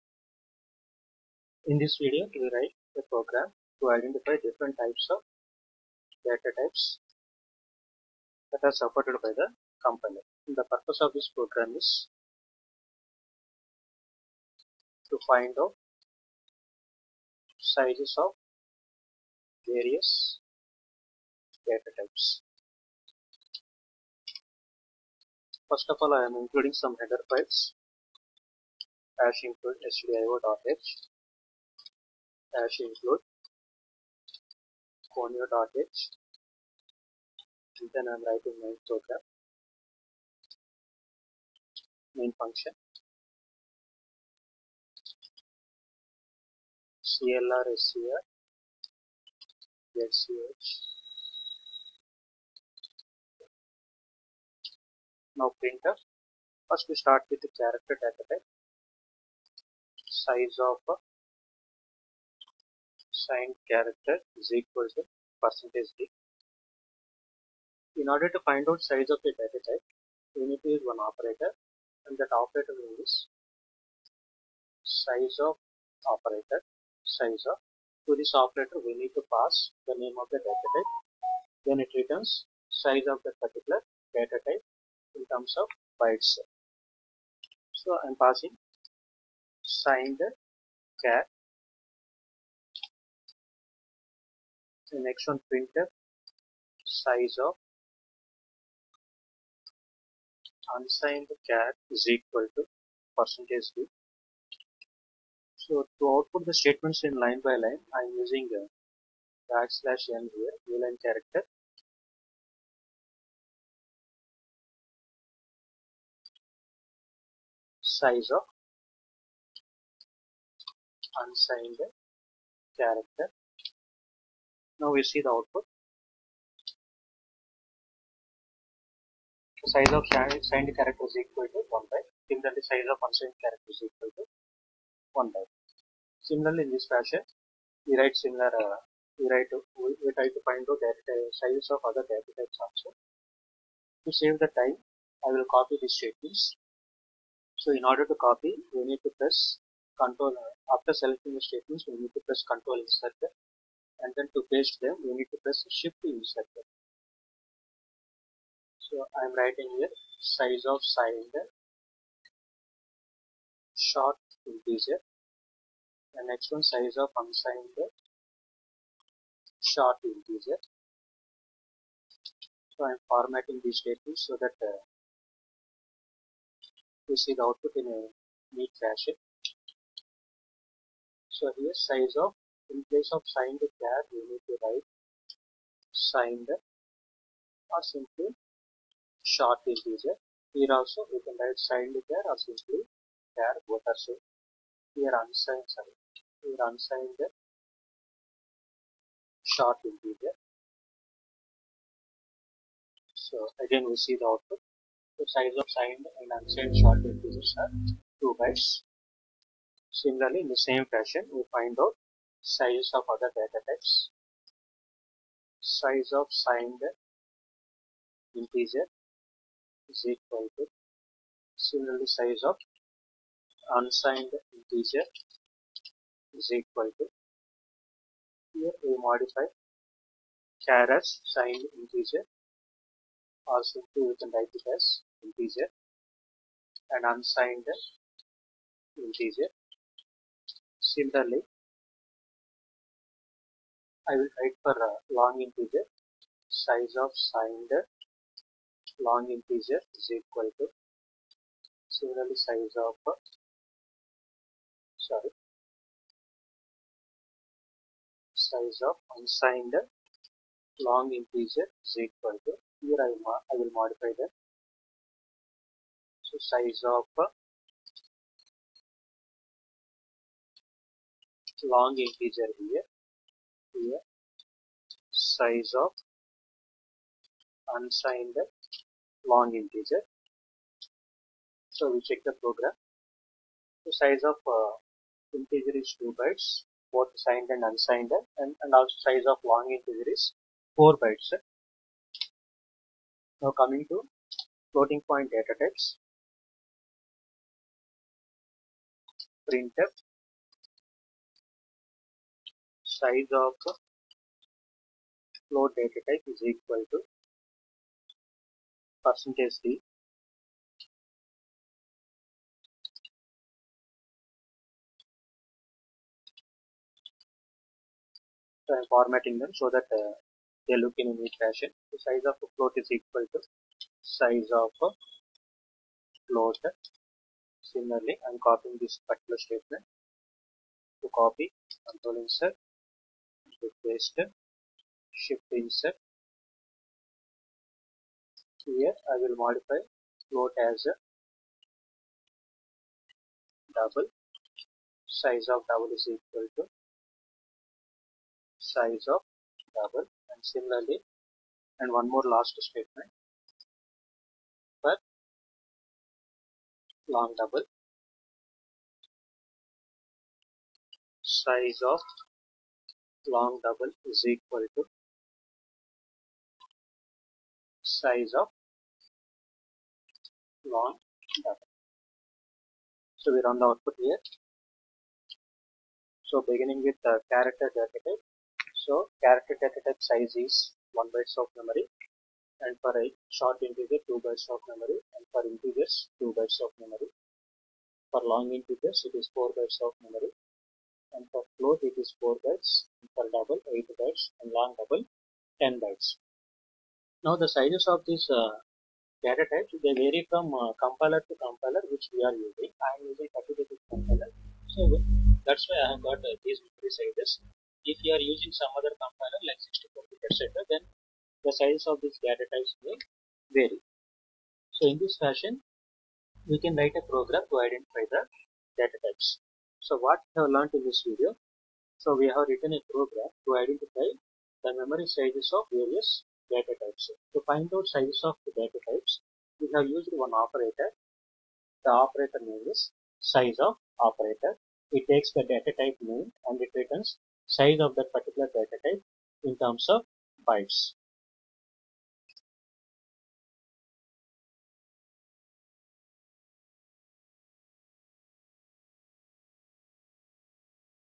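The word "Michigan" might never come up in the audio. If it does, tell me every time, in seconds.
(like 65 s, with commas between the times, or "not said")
not said.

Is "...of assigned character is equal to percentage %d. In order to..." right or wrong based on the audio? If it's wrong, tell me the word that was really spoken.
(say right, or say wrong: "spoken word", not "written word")
right.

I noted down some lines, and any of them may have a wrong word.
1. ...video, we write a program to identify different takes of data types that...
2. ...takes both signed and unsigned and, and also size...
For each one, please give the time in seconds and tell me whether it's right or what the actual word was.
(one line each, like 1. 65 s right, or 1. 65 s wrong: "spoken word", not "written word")
1. 2 s wrong: "types", not "takes"
2. 286 s wrong: "bytes", not "takes".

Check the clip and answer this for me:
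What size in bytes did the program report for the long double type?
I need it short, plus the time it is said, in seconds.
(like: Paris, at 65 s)
10 bytes, at 395 s.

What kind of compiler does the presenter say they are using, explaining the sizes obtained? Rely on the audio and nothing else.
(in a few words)
32 bit compiler.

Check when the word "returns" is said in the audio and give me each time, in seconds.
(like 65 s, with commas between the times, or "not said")
81 s, 436 s.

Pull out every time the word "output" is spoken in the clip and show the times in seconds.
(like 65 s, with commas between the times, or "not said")
106 s, 125 s, 177 s, 204 s, 373 s.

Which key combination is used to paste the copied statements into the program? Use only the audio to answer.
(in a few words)
Shift Insert.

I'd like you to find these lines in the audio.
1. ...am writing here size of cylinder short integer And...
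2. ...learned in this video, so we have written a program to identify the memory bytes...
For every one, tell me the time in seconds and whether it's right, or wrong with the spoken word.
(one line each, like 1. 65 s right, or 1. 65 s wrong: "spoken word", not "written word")
1. 159 s right
2. 420 s wrong: "sizes", not "bytes".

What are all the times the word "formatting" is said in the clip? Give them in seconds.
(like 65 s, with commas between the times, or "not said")
173 s, 318 s.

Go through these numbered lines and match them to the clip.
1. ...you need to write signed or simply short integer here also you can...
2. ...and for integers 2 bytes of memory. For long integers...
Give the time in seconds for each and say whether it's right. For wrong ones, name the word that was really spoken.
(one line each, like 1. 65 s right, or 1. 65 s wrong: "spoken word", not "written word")
1. 184 s right
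2. 385 s right.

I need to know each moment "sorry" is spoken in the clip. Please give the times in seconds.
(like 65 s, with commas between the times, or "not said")
195 s, 254 s.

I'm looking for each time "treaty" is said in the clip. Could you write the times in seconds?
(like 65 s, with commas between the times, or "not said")
not said.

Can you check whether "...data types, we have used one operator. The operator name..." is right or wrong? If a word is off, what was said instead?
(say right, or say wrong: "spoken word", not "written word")
right.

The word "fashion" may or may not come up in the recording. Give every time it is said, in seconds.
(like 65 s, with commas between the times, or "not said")
136 s, 178 s, 210 s, 321 s, 415 s.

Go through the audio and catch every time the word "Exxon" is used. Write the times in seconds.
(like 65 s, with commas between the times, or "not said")
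95 s.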